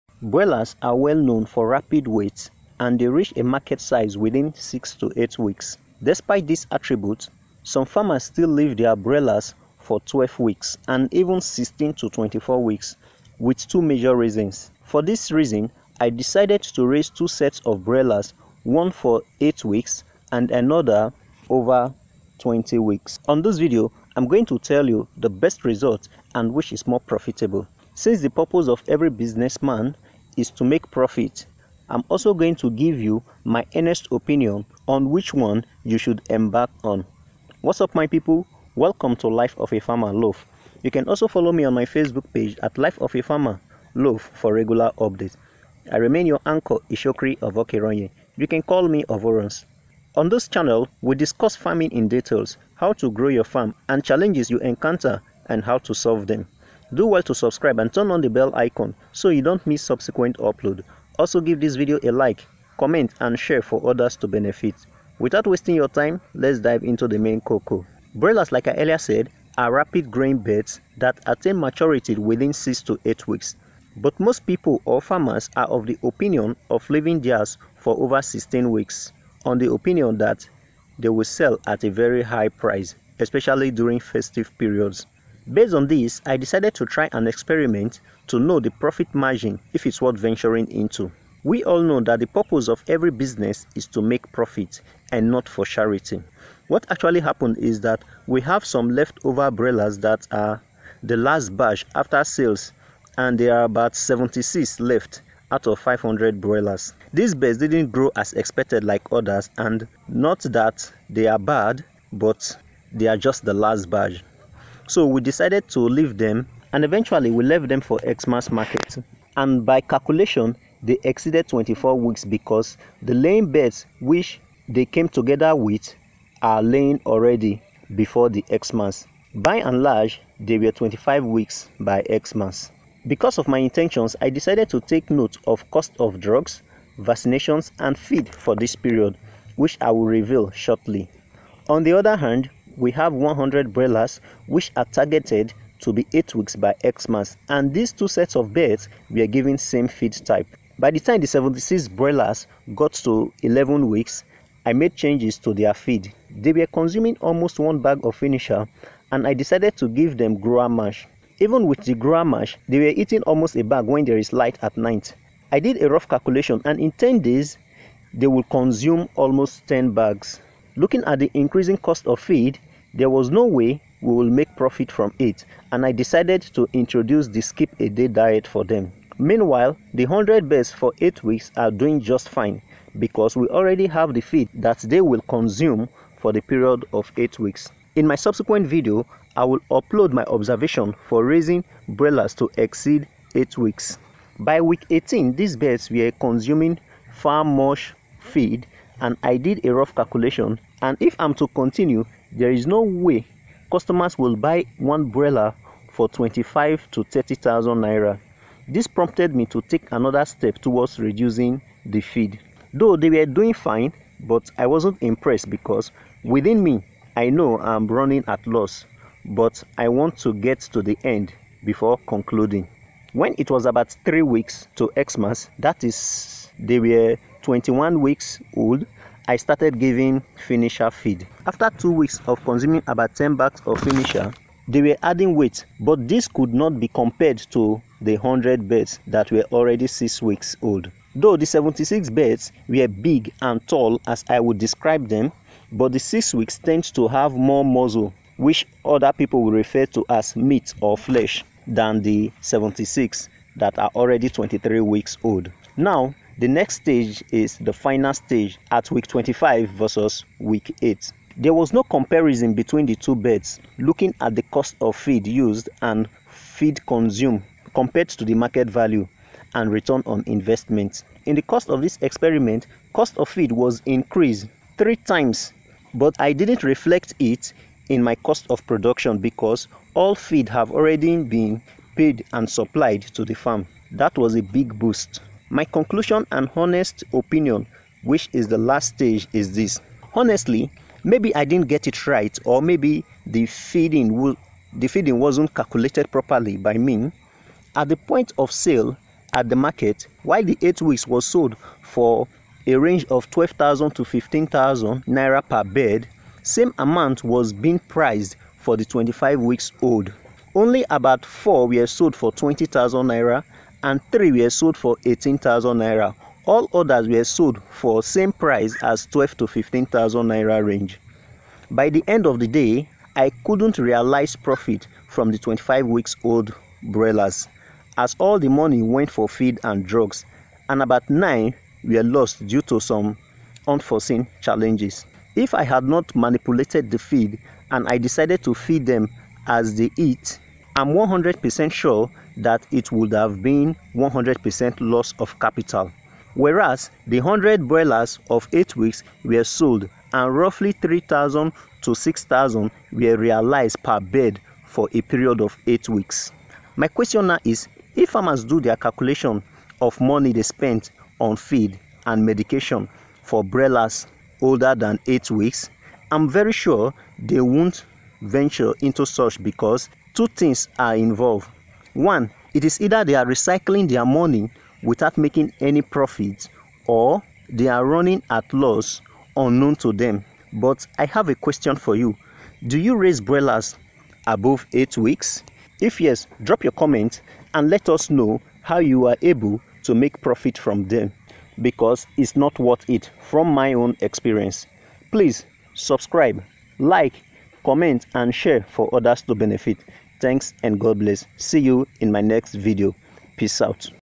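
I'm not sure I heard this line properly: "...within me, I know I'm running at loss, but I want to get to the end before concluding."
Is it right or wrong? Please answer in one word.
right.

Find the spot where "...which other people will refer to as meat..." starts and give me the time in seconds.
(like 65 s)
248 s.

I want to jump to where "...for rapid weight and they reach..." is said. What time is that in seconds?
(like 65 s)
1 s.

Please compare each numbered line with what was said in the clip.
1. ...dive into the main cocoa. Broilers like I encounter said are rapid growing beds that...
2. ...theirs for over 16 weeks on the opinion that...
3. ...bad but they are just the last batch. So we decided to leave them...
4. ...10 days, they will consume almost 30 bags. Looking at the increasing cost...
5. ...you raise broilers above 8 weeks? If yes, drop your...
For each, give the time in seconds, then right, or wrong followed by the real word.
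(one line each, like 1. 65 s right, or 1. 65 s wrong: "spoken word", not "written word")
1. 66 s wrong: "earlier", not "encounter"
2. 77 s right
3. 111 s right
4. 166 s wrong: "10", not "30"
5. 382 s right.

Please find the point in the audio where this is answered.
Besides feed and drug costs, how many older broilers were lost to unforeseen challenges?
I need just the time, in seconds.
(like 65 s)
330 s.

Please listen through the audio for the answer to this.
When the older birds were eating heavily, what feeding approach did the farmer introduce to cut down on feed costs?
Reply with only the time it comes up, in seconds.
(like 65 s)
177 s.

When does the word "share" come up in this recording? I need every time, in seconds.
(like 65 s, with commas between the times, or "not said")
63 s, 398 s.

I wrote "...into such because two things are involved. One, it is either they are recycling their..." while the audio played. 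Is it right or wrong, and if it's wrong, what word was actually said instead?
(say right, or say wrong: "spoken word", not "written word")
right.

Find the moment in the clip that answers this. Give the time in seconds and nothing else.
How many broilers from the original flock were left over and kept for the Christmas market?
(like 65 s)
103 s.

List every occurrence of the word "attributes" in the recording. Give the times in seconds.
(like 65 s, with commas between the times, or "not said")
6 s.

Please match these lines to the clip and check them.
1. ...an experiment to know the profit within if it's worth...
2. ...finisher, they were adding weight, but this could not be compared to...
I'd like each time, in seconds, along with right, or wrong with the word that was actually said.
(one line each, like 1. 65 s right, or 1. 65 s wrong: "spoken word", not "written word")
1. 87 s wrong: "margin", not "within"
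2. 233 s right.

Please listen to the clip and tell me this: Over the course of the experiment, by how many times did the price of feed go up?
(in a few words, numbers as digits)
3 times.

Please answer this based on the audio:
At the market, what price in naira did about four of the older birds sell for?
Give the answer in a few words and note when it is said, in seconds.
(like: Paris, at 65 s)
20,000 naira, at 312 s.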